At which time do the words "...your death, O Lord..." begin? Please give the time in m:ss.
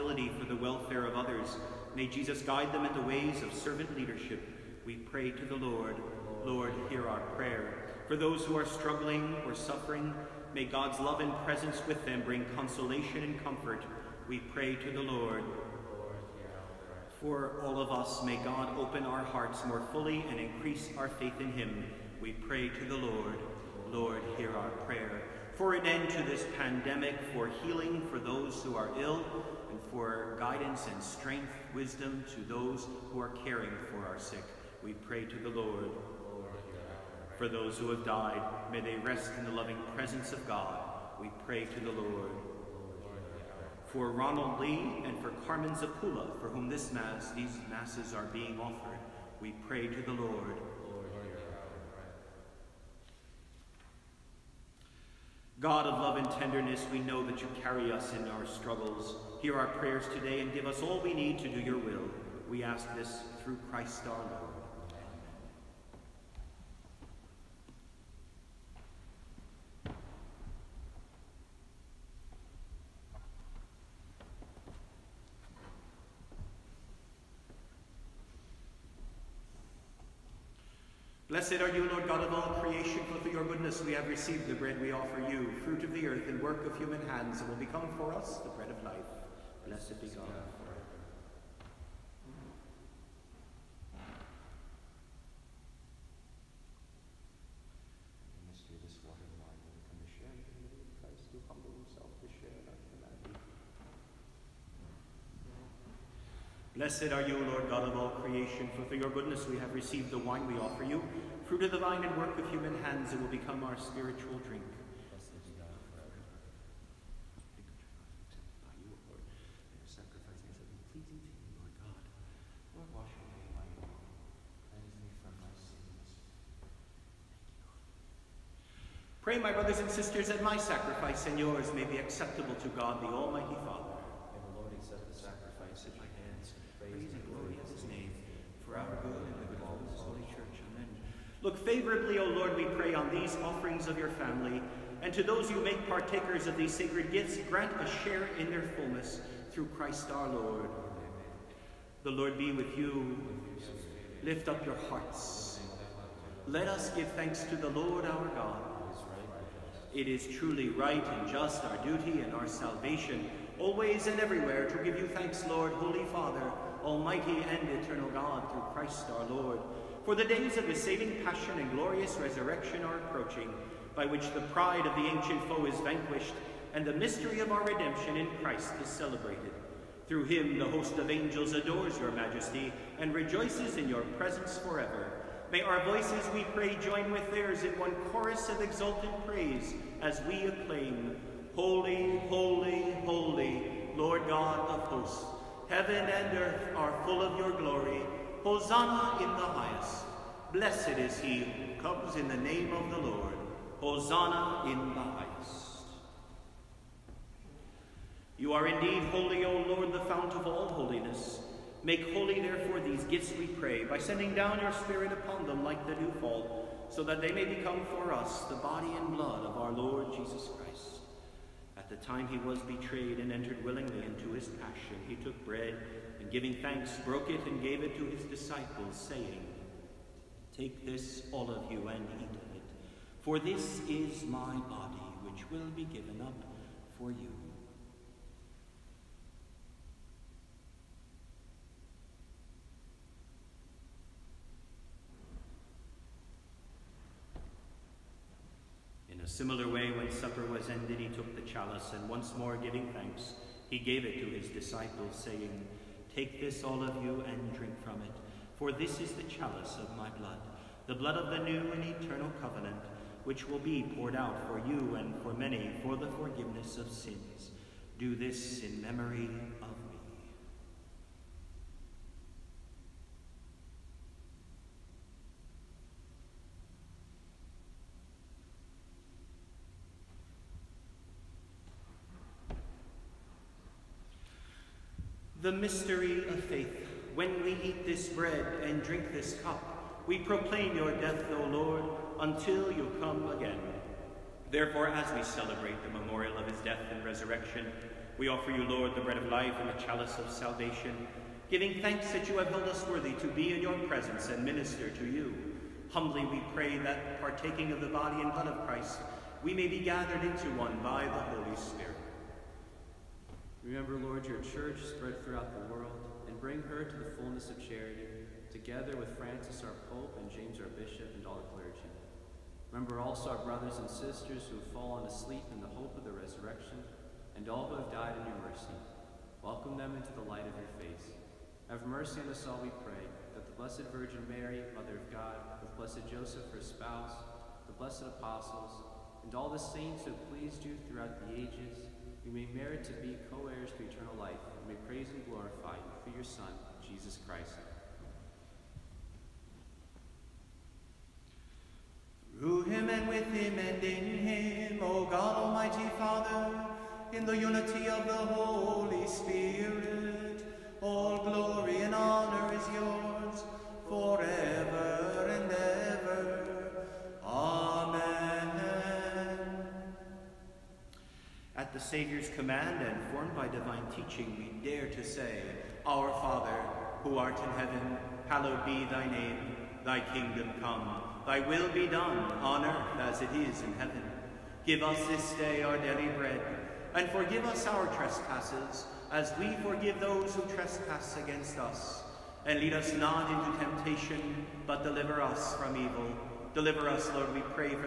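4:50.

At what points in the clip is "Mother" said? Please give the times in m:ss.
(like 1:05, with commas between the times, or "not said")
5:34.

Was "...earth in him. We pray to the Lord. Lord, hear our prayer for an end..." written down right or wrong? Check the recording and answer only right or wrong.
wrong.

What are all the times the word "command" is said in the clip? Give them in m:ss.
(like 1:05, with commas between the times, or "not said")
6:12.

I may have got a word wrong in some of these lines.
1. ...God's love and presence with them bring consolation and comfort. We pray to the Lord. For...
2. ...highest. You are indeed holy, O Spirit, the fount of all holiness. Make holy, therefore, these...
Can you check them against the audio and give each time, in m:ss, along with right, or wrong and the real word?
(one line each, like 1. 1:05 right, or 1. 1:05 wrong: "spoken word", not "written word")
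1. 0:10 right
2. 3:24 wrong: "Lord", not "Spirit".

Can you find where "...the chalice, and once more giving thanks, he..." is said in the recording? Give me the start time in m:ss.
4:11.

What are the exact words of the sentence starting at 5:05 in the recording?
Humbly we pray that, partaking of the body and blood of Christ, we may be gathered into one by the Holy Spirit.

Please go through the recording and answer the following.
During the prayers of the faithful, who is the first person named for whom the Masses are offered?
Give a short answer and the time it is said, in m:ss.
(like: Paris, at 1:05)
Ronald Lee, at 0:44.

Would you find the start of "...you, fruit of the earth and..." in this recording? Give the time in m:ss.
1:25.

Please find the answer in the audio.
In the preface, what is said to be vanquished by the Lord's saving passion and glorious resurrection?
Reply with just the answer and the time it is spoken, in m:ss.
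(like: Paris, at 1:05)
The pride of the ancient foe, at 2:54.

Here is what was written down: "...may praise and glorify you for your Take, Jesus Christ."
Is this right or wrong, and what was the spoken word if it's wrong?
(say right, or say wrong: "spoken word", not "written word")
wrong: "Son", not "Take".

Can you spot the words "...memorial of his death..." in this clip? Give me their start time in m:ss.
4:55.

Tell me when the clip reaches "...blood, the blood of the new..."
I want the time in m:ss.
4:20.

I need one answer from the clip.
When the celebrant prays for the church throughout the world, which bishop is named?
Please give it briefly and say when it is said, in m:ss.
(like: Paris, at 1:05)
James, at 5:20.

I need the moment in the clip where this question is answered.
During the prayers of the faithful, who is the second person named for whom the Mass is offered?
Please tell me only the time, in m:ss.
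0:45.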